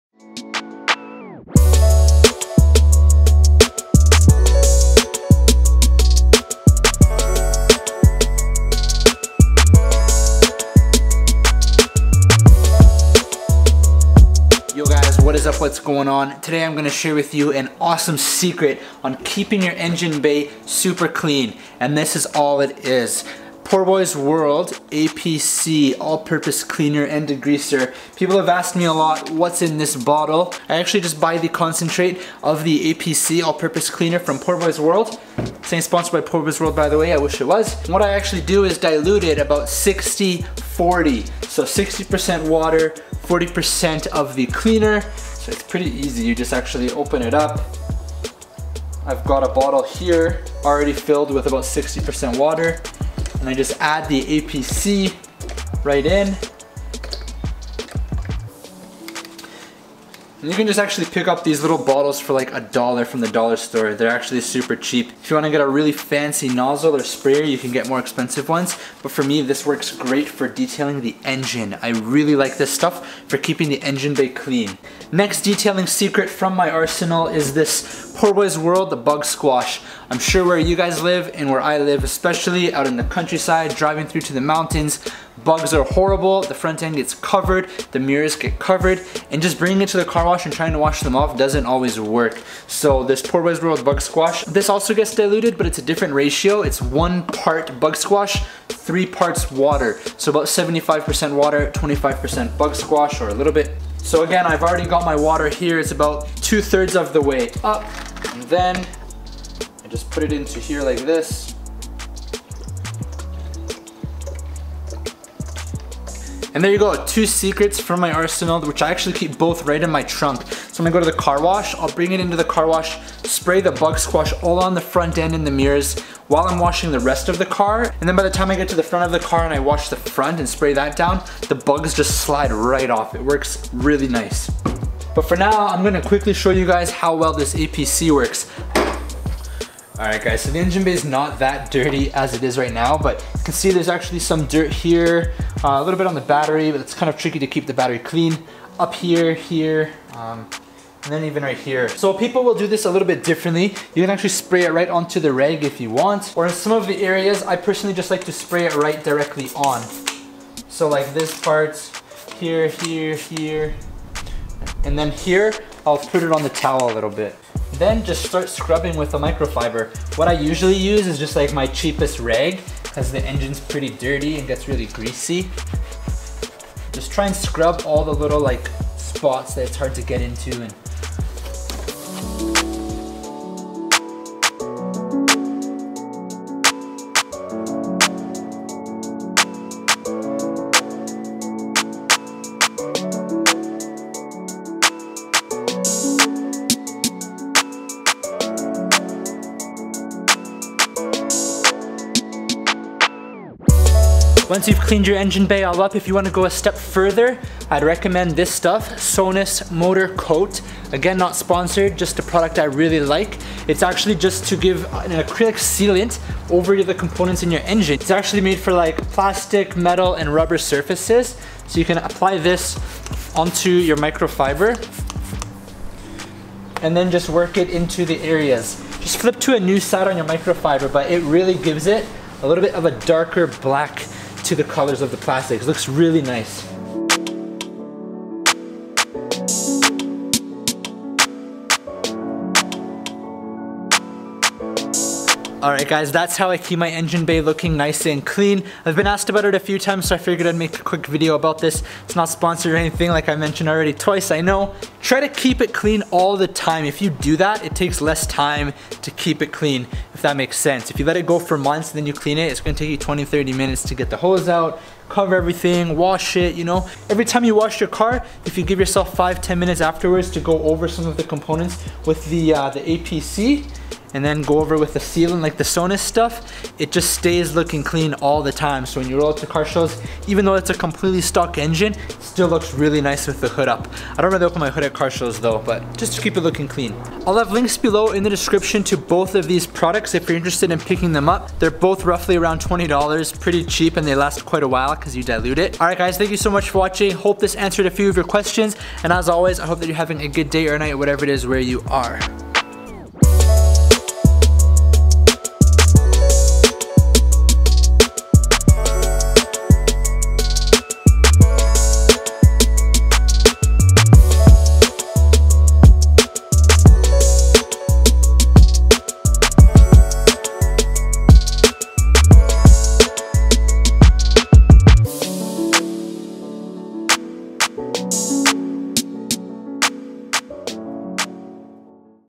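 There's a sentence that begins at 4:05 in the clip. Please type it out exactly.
Alright guys, that's how I keep my engine bay looking nice and clean.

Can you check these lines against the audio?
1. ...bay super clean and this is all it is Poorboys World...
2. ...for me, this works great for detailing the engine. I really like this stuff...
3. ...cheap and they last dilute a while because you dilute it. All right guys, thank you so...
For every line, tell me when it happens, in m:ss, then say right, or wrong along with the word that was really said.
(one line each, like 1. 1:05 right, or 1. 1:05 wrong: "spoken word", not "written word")
1. 0:20 right
2. 1:09 right
3. 4:53 wrong: "quite", not "dilute".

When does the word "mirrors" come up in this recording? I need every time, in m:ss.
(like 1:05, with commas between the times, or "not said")
1:27, 2:05.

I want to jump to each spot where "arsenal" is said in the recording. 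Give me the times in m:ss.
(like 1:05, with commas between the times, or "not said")
1:16, 1:58.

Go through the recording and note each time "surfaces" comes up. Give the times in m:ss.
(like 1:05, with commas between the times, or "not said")
3:40.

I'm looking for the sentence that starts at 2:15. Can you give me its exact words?
But for now, I'm gonna quickly show you guys how well this APC works.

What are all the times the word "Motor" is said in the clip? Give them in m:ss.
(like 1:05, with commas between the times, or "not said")
3:29.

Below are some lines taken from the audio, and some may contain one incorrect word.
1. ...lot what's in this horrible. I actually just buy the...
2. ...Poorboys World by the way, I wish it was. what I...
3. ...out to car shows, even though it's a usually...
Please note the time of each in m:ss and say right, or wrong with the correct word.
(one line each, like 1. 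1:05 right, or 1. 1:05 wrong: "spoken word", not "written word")
1. 0:28 wrong: "bottle", not "horrible"
2. 0:36 right
3. 4:39 wrong: "completely", not "usually".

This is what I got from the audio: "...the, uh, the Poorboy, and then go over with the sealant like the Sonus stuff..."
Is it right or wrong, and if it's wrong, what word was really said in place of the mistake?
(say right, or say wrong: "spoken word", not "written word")
wrong: "APC", not "Poorboy".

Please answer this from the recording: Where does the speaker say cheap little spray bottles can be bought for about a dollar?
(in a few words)
the dollar store.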